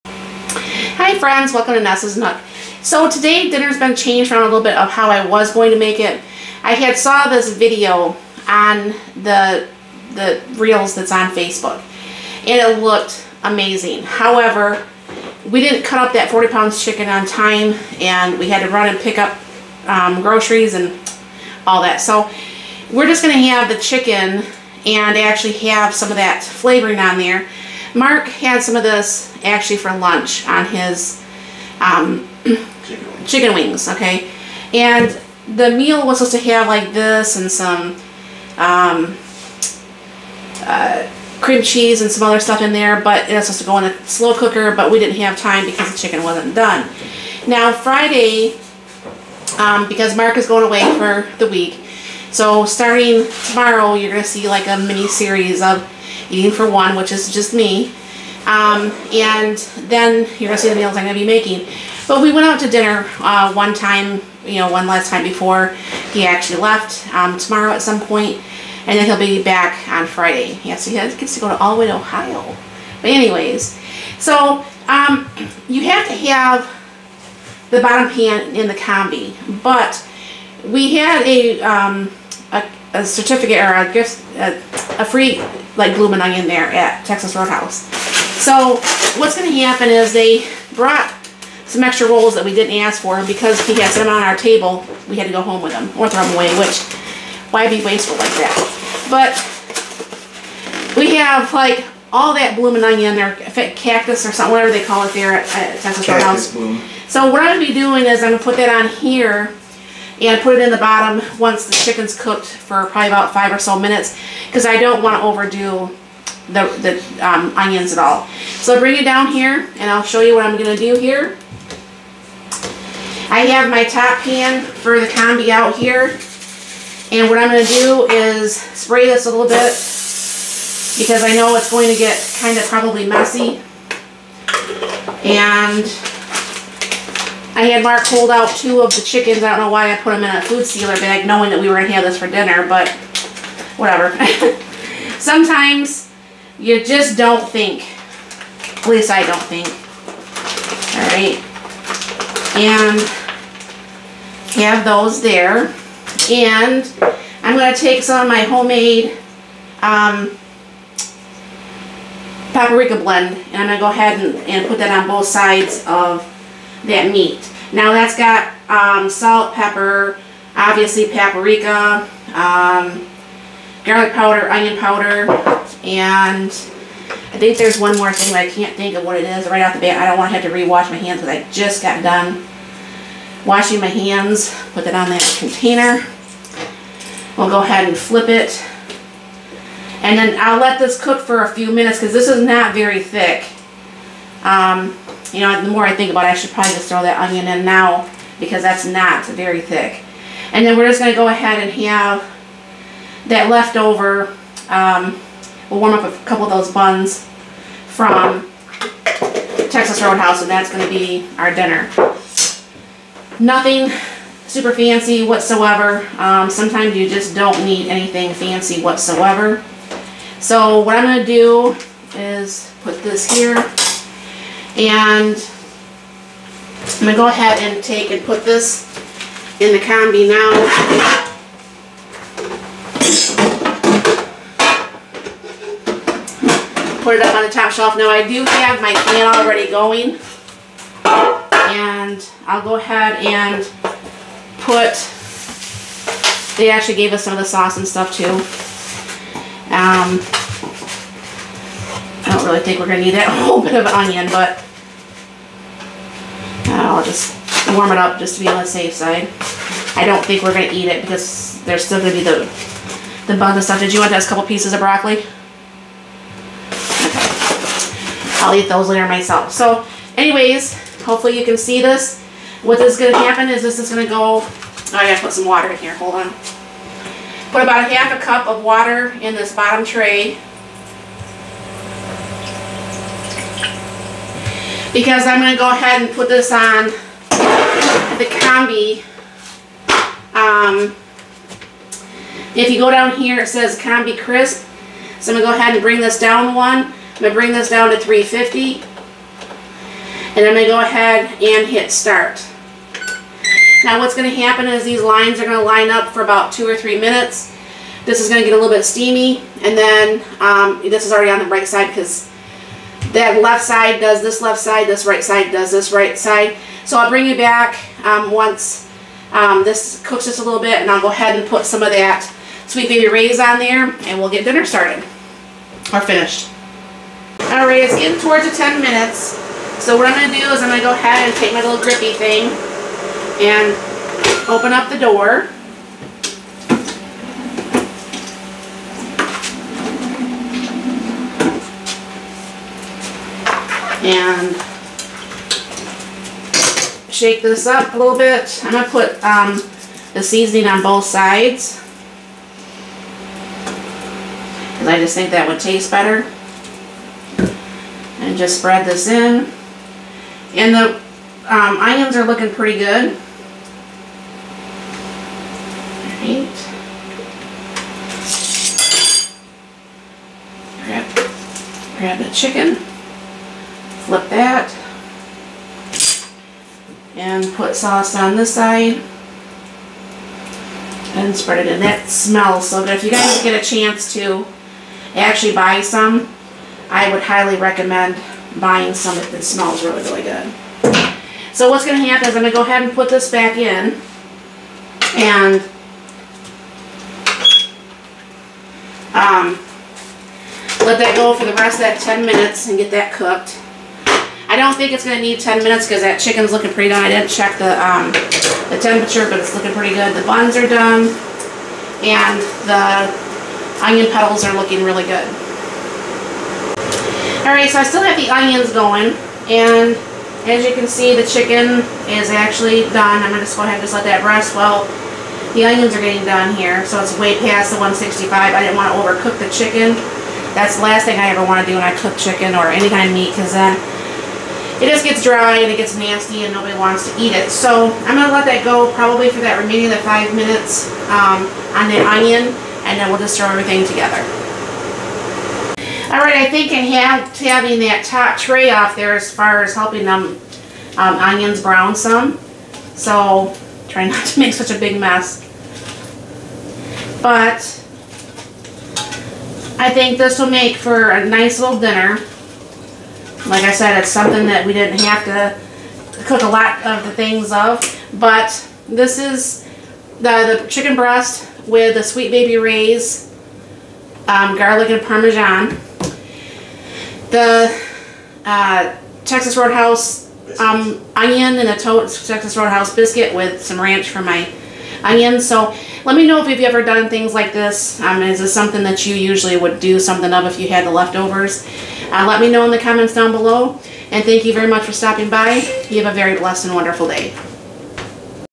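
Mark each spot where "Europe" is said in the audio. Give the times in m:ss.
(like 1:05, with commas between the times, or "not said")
not said.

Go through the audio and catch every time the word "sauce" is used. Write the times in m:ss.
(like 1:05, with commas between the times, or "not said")
4:07, 6:17.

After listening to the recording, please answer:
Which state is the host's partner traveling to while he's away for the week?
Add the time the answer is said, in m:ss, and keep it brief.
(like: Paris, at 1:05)
Ohio, at 1:11.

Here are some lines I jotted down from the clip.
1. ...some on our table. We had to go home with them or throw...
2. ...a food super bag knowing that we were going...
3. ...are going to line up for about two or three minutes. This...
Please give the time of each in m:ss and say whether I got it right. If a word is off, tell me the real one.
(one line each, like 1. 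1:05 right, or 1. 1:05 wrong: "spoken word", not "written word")
1. 1:33 right
2. 2:20 wrong: "sealer", not "super"
3. 5:05 right.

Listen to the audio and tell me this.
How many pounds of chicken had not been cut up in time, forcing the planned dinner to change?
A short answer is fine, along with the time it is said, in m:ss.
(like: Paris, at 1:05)
40, at 0:16.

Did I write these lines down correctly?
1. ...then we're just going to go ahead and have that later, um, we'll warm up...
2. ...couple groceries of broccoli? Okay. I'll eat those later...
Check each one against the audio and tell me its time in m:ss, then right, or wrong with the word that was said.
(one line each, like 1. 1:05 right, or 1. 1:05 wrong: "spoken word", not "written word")
1. 3:20 wrong: "leftover", not "later"
2. 4:24 wrong: "pieces", not "groceries".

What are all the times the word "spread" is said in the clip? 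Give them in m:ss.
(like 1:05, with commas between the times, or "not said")
5:58, 6:21.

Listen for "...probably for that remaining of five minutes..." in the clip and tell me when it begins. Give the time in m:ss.
7:18.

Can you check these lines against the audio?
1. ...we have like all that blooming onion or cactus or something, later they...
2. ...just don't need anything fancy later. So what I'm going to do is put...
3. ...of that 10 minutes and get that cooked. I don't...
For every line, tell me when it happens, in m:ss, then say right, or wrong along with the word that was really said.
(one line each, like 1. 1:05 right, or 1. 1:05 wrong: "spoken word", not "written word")
1. 1:40 wrong: "whatever", not "later"
2. 3:37 wrong: "whatsoever", not "later"
3. 6:41 right.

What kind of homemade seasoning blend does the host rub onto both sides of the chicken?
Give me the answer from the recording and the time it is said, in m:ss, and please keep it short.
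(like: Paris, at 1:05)
Paprika blend, at 2:42.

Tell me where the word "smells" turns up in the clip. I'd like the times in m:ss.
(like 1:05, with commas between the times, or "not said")
6:22, 6:29.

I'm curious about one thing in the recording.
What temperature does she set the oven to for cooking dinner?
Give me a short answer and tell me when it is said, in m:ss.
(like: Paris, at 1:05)
350, at 4:57.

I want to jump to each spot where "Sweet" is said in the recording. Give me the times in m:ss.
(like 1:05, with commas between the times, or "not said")
5:22, 7:52.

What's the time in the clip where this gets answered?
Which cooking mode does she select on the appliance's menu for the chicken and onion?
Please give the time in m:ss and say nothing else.
4:53.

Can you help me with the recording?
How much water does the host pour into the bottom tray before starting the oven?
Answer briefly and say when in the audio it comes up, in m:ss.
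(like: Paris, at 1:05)
Half a cup, at 4:37.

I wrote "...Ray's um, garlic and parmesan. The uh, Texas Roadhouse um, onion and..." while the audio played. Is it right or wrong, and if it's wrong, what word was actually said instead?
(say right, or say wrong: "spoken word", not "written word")
right.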